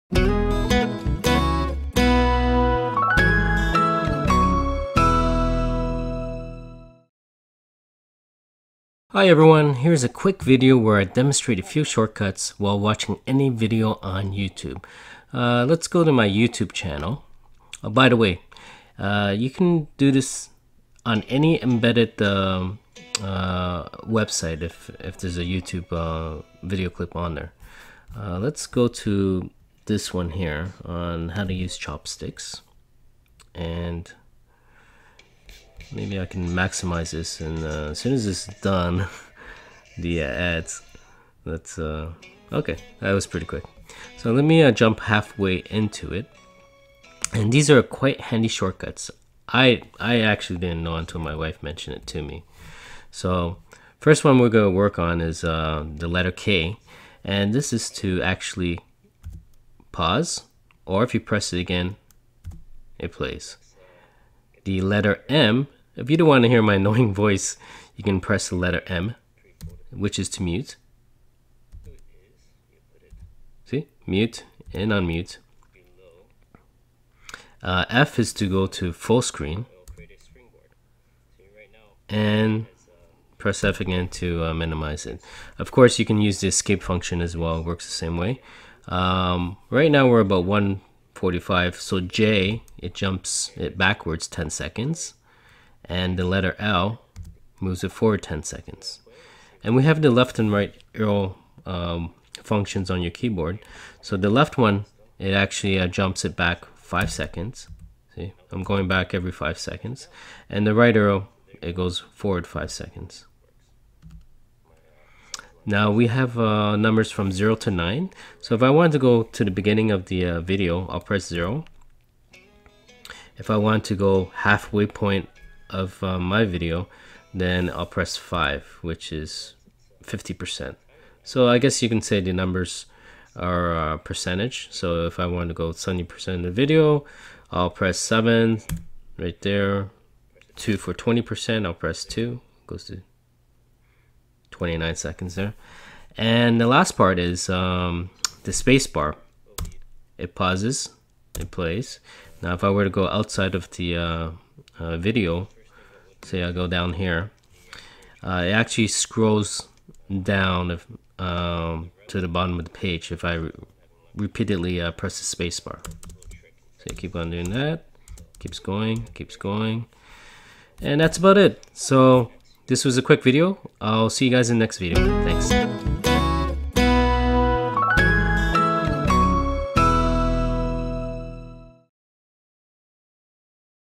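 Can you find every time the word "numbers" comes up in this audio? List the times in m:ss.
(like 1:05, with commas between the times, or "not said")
1:56, 2:12.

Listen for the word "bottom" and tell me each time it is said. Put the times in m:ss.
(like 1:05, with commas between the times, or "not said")
2:42.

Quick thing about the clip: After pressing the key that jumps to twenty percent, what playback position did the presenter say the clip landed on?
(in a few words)
29 seconds.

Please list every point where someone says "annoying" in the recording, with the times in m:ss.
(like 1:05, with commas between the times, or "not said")
1:06.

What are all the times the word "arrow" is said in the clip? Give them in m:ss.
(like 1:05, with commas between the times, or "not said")
1:40, 1:50.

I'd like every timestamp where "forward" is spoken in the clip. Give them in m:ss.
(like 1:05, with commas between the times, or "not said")
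1:37, 1:52.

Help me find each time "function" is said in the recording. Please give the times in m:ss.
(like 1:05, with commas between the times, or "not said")
1:26, 1:42.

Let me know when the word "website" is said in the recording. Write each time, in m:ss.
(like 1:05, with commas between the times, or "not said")
0:24.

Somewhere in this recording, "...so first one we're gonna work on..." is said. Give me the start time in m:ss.
0:53.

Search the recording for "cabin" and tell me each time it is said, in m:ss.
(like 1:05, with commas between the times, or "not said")
not said.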